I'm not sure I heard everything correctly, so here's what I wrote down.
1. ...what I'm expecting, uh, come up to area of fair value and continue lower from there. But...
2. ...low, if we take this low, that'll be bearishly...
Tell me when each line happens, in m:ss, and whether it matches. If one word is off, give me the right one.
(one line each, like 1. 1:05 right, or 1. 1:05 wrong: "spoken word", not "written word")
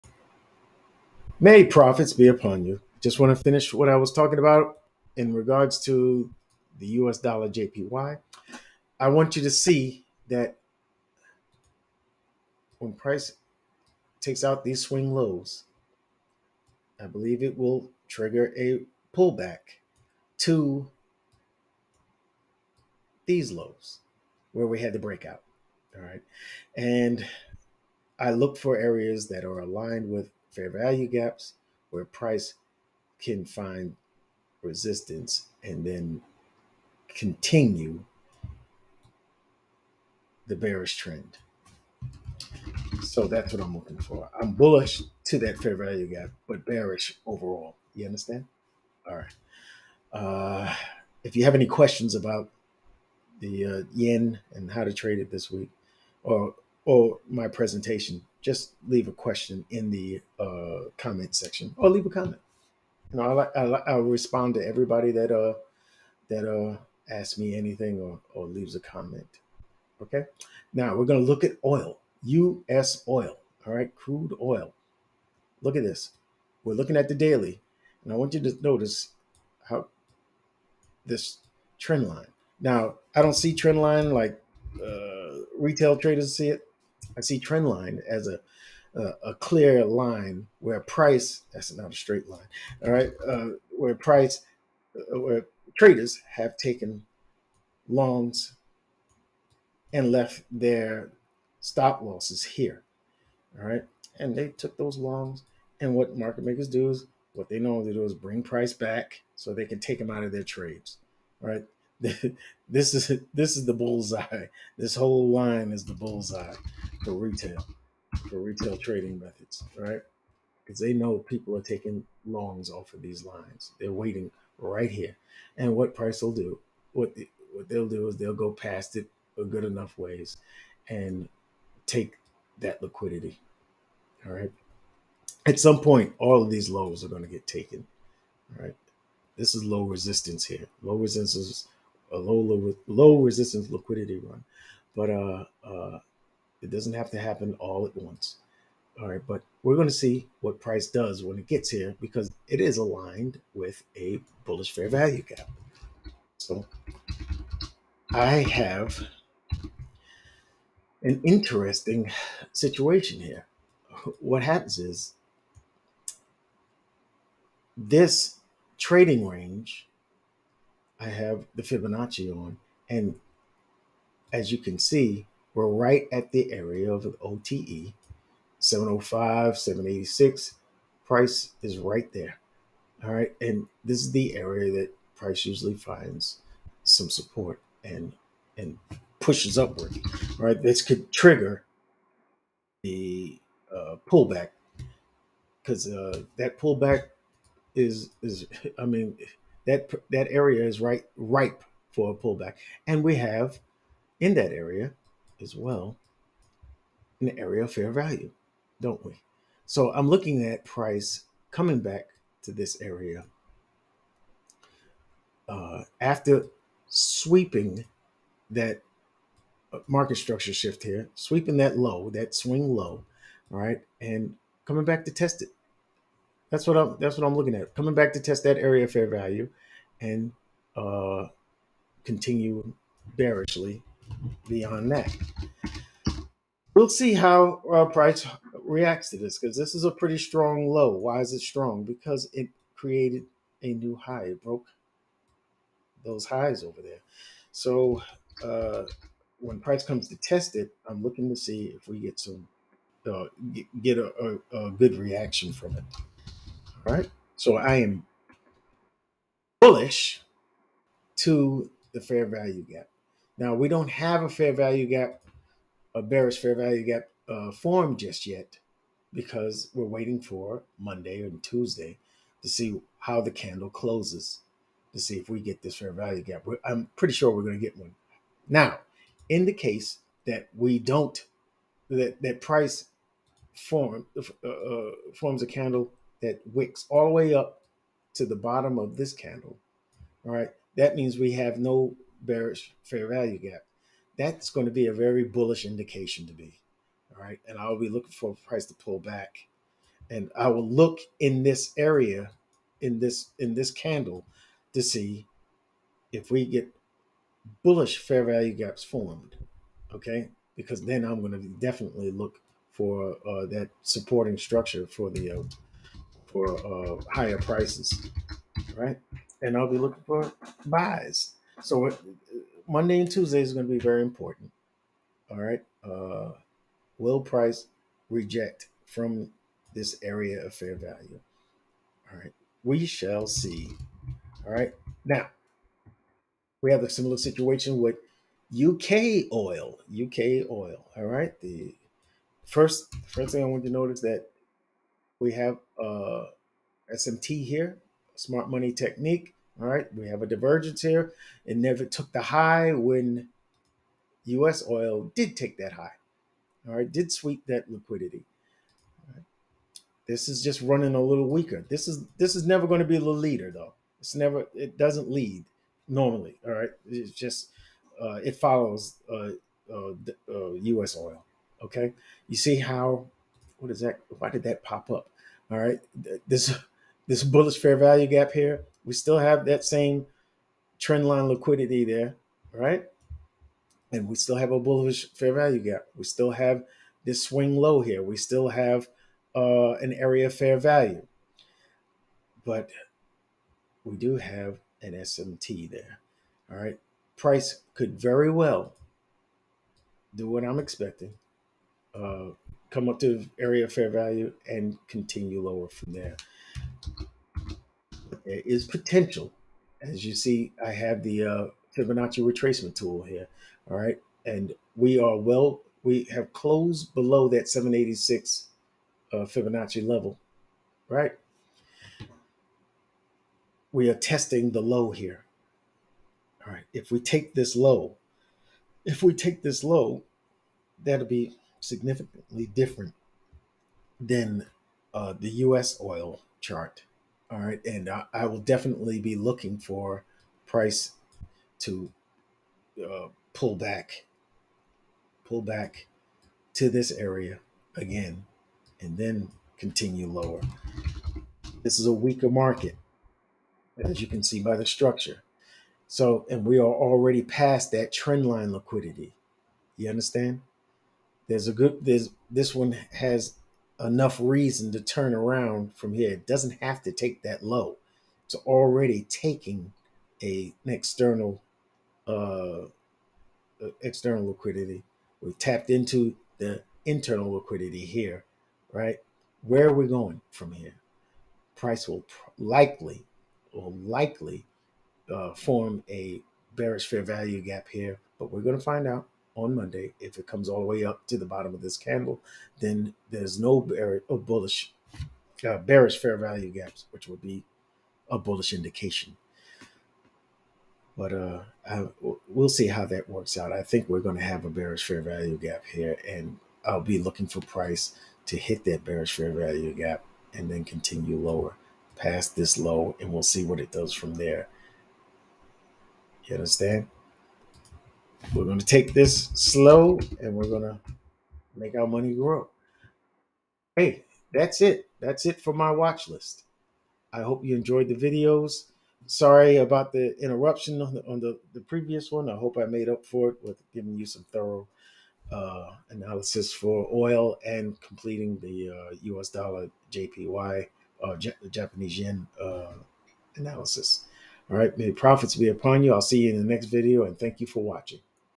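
1. 6:40 right
2. 7:07 wrong: "significantly", not "bearishly".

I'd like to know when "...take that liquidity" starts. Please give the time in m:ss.
2:11.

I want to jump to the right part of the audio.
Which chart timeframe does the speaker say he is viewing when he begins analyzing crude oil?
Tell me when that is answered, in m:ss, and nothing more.
1:17.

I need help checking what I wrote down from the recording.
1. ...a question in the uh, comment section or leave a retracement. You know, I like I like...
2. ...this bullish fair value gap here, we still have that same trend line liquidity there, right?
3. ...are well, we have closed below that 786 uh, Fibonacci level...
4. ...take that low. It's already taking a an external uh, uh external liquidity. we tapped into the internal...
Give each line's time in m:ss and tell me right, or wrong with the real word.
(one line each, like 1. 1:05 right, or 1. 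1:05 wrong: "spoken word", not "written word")
1. 0:59 wrong: "comment", not "retracement"
2. 6:17 right
3. 6:54 right
4. 7:46 right.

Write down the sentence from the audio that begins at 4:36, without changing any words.
I'm pretty sure we're going to get one.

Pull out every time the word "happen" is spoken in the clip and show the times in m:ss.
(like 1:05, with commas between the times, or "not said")
2:27, 2:44.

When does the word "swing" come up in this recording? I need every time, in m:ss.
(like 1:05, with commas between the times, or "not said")
0:14, 3:42, 6:27.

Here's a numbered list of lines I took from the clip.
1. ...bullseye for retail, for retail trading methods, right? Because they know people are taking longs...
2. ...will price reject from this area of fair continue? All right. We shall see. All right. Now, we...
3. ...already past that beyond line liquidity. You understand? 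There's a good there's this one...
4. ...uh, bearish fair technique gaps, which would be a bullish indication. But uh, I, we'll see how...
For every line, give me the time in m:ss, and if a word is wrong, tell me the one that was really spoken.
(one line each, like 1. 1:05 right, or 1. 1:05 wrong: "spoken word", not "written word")
1. 1:55 right
2. 5:26 wrong: "value", not "continue"
3. 7:36 wrong: "trend", not "beyond"
4. 8:15 wrong: "value", not "technique".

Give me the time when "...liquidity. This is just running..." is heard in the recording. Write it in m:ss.
5:57.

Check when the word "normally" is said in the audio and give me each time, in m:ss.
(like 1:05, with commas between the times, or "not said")
1:47, 6:05.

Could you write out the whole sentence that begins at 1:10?
Okay, now we're gonna look at oil, U.S.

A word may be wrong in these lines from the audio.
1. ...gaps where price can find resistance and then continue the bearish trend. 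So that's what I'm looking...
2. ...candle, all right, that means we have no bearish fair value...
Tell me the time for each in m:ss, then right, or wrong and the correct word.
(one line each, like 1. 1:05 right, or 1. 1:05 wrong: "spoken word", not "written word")
1. 0:31 right
2. 4:49 right.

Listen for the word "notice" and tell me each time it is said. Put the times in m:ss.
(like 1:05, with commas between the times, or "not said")
1:18, 5:43.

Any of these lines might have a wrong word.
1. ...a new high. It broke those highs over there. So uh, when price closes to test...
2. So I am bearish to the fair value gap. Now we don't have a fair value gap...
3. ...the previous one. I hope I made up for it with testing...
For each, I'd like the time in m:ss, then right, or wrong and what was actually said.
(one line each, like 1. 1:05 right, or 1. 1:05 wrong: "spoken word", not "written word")
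1. 4:03 wrong: "comes", not "closes"
2. 4:17 wrong: "bullish", not "bearish"
3. 8:51 wrong: "giving", not "testing".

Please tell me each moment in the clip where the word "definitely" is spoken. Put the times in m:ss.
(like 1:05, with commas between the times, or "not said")
5:11, 7:18.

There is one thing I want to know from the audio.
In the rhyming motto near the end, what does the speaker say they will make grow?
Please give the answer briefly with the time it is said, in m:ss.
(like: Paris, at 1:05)
Our money, at 8:41.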